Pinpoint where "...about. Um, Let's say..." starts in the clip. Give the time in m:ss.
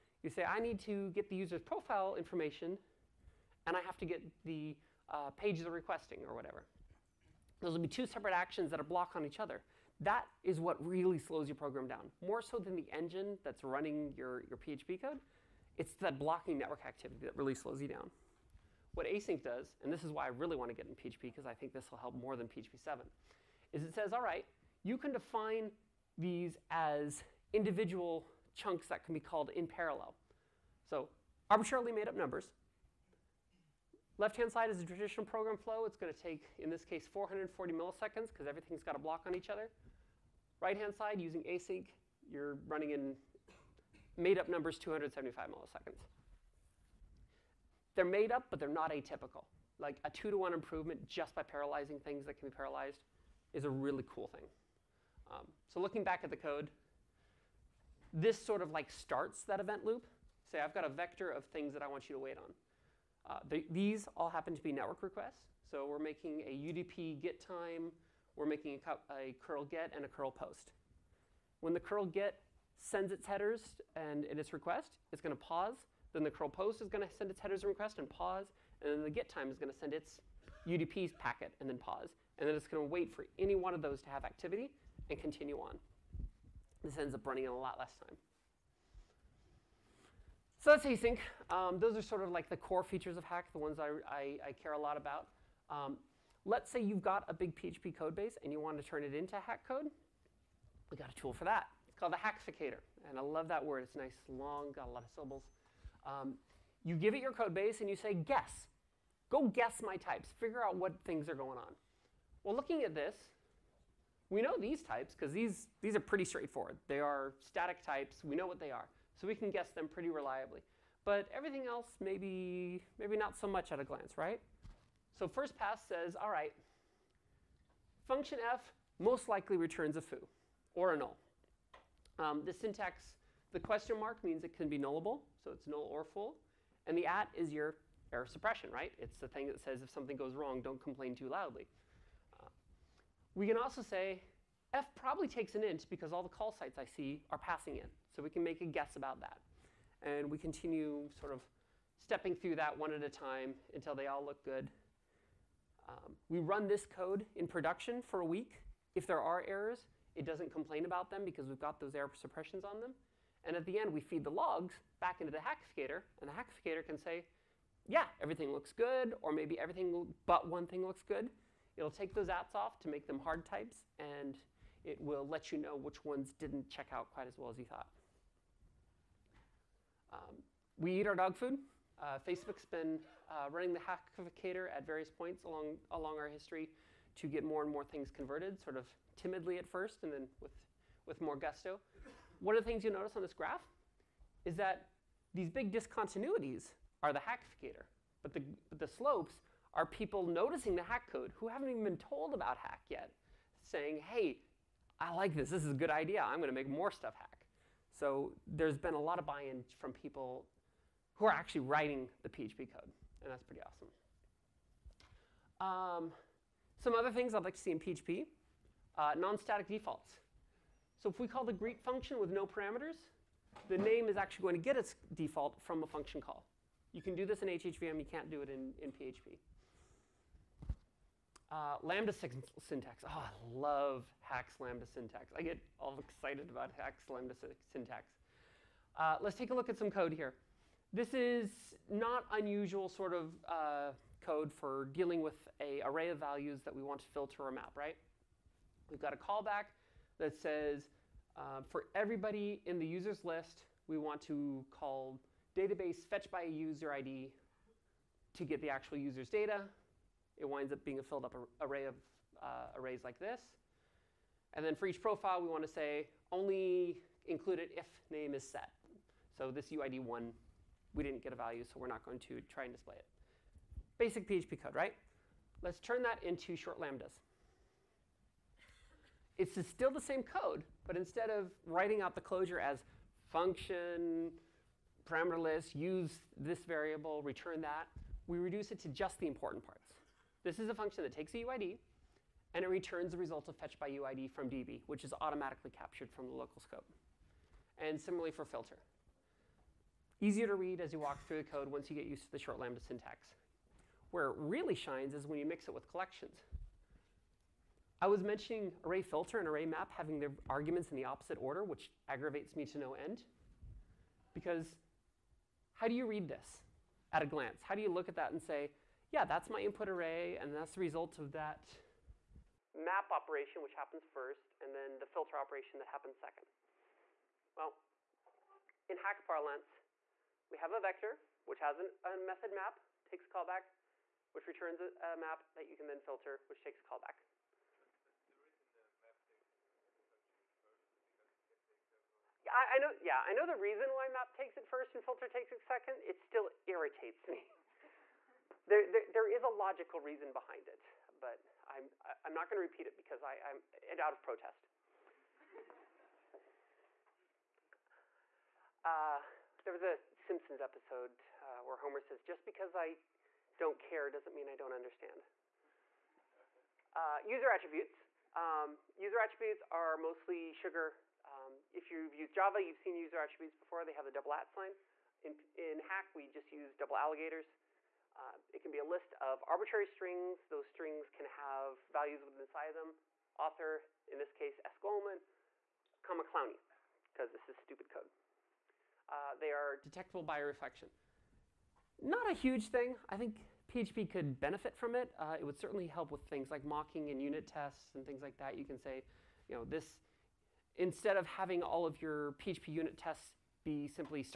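1:34.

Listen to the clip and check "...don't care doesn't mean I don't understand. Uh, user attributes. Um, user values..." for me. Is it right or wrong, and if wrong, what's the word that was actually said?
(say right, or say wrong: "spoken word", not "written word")
wrong: "attributes", not "values".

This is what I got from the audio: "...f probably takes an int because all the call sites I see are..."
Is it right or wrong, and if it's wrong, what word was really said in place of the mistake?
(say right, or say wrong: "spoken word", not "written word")
right.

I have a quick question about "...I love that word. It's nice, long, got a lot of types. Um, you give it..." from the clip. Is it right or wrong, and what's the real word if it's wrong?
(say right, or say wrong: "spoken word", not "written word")
wrong: "syllables", not "types".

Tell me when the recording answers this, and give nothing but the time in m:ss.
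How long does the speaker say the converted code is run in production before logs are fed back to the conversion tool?
2:38.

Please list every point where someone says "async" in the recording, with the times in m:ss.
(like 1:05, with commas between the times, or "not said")
0:19, 0:41, 1:30.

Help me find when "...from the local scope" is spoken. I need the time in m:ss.
4:56.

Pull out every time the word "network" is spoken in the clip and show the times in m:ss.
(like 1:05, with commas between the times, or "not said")
0:16, 1:04.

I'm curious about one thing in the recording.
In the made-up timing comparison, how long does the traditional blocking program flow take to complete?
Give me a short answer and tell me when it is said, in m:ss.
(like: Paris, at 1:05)
440 milliseconds, at 0:37.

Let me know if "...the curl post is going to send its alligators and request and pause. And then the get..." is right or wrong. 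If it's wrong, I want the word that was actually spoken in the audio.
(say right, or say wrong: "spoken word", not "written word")
wrong: "headers", not "alligators".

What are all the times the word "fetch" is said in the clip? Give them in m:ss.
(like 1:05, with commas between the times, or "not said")
4:16, 4:53.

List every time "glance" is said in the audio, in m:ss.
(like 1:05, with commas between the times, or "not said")
2:03, 5:17.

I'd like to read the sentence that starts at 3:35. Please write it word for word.
Um, some other things I'd like to see in PHP, uh, non-static defaults.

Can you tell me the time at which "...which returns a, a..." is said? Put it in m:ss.
5:34.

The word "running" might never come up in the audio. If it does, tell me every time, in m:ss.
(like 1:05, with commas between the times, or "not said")
0:13, 0:42, 1:27, 3:03.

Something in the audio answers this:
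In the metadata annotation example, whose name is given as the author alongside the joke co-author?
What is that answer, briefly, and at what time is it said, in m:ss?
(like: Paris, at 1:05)
S. Golemon, at 6:24.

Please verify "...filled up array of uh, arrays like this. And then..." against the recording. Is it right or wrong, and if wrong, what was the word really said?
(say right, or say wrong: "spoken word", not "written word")
right.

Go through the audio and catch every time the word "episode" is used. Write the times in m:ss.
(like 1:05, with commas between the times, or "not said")
6:00.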